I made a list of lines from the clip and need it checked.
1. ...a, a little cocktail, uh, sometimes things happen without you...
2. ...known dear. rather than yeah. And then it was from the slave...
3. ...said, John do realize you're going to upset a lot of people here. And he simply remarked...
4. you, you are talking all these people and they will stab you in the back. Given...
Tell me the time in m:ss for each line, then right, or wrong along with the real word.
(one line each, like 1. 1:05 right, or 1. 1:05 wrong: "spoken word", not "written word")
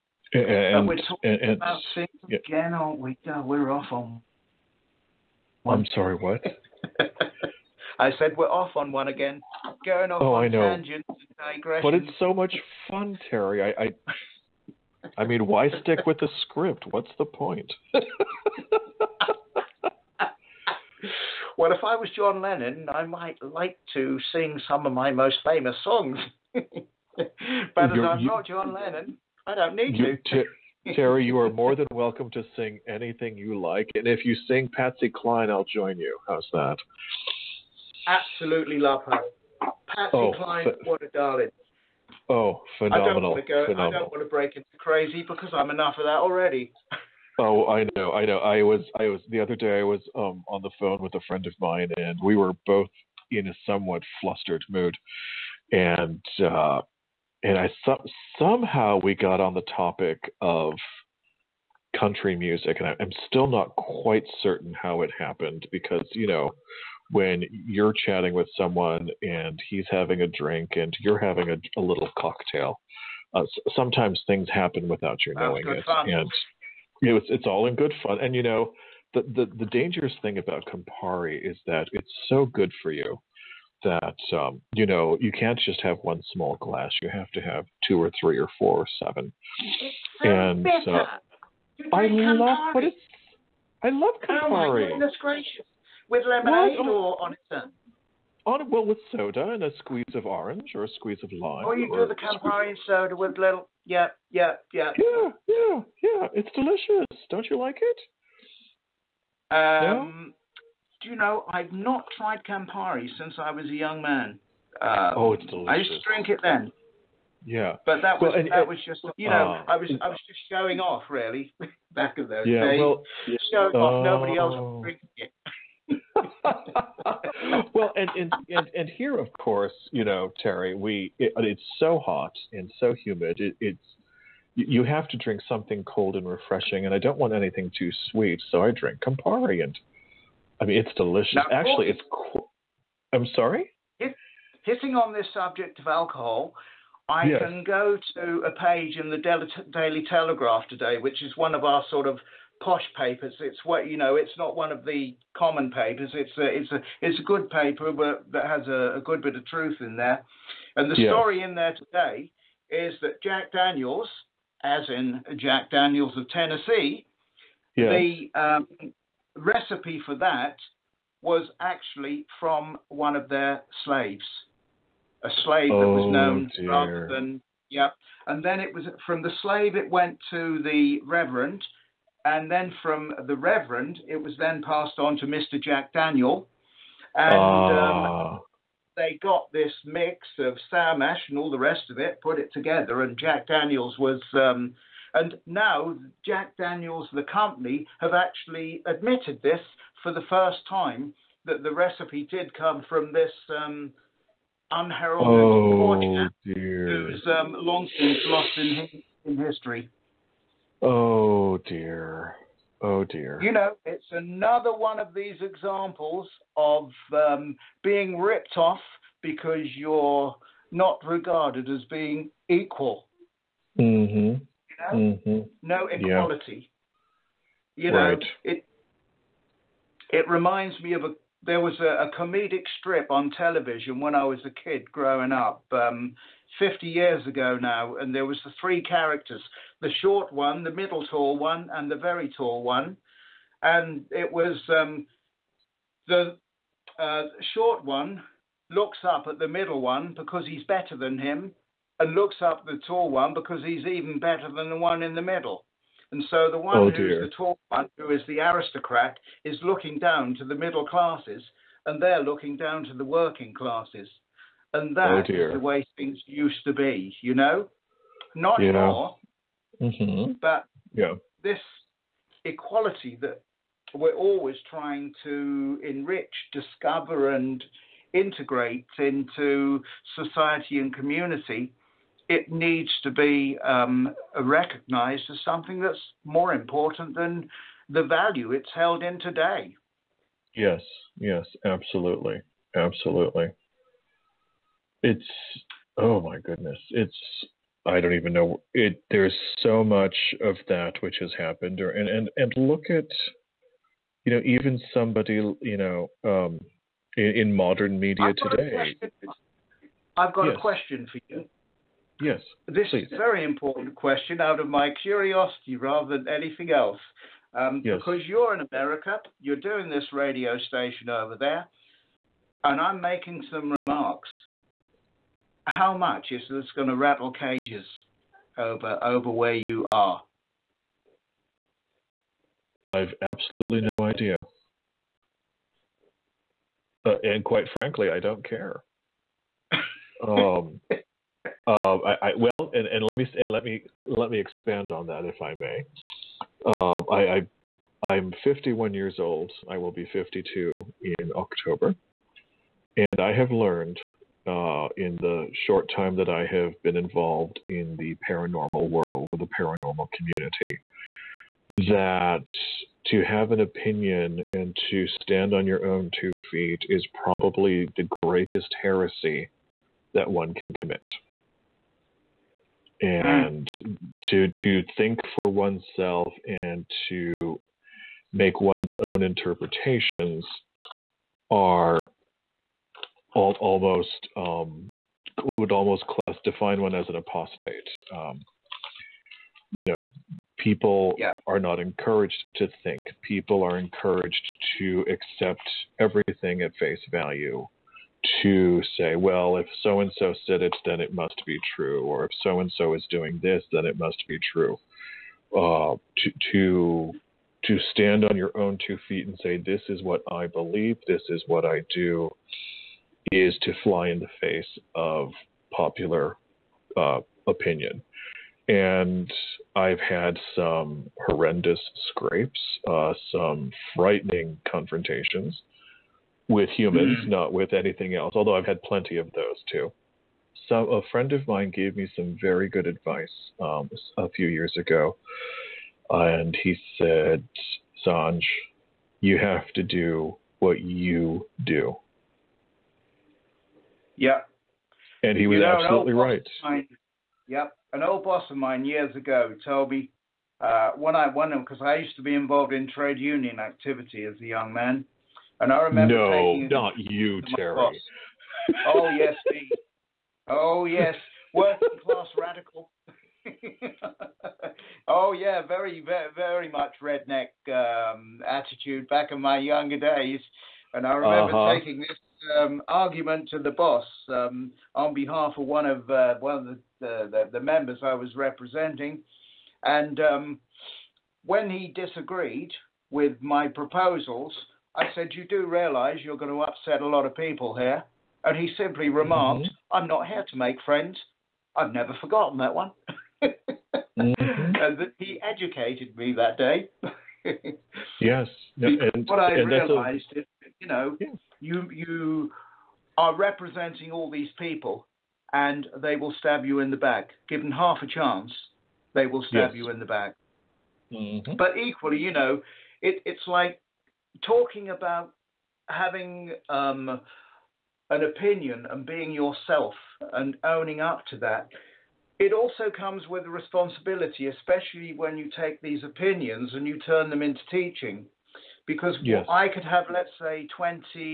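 1. 1:11 right
2. 2:56 right
3. 8:05 wrong: "You", not "John"
4. 8:21 wrong: "representing", not "talking".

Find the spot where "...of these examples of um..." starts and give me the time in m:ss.
3:34.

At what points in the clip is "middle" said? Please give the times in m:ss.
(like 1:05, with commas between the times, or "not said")
4:00, 4:09, 4:15, 4:20.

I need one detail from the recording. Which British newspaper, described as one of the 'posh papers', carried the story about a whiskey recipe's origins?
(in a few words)
Daily Telegraph.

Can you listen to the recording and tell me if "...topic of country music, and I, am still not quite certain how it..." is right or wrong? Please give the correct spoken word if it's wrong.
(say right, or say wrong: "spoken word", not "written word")
right.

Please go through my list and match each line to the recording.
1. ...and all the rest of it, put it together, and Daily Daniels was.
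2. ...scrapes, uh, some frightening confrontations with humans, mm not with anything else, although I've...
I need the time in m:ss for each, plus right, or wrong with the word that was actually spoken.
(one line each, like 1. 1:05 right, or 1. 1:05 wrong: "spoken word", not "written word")
1. 3:11 wrong: "Jack", not "Daily"
2. 7:02 right.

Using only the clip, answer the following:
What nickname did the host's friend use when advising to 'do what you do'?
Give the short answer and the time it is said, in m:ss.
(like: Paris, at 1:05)
Sanj, at 7:18.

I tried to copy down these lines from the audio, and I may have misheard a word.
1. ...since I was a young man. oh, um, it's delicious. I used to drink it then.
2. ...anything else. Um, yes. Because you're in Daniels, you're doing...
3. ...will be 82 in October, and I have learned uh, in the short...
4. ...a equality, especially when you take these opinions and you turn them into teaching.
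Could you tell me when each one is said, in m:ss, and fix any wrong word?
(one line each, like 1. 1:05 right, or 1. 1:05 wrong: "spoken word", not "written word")
1. 1:53 right
2. 5:16 wrong: "America", not "Daniels"
3. 5:49 wrong: "52", not "82"
4. 8:43 wrong: "responsibility", not "equality".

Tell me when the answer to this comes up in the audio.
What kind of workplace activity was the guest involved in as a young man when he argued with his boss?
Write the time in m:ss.
7:32.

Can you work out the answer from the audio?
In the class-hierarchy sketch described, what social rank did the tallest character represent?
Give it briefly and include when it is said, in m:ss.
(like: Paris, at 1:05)
aristocrat, at 4:18.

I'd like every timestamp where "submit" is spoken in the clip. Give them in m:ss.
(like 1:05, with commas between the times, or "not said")
not said.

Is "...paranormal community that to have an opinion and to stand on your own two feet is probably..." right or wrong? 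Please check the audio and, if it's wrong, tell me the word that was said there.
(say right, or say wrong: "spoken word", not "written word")
right.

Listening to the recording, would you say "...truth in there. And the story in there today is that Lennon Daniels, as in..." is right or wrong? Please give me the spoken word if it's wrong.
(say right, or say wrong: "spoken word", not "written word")
wrong: "Jack", not "Lennon".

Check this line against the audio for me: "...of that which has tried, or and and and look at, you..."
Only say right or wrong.
wrong.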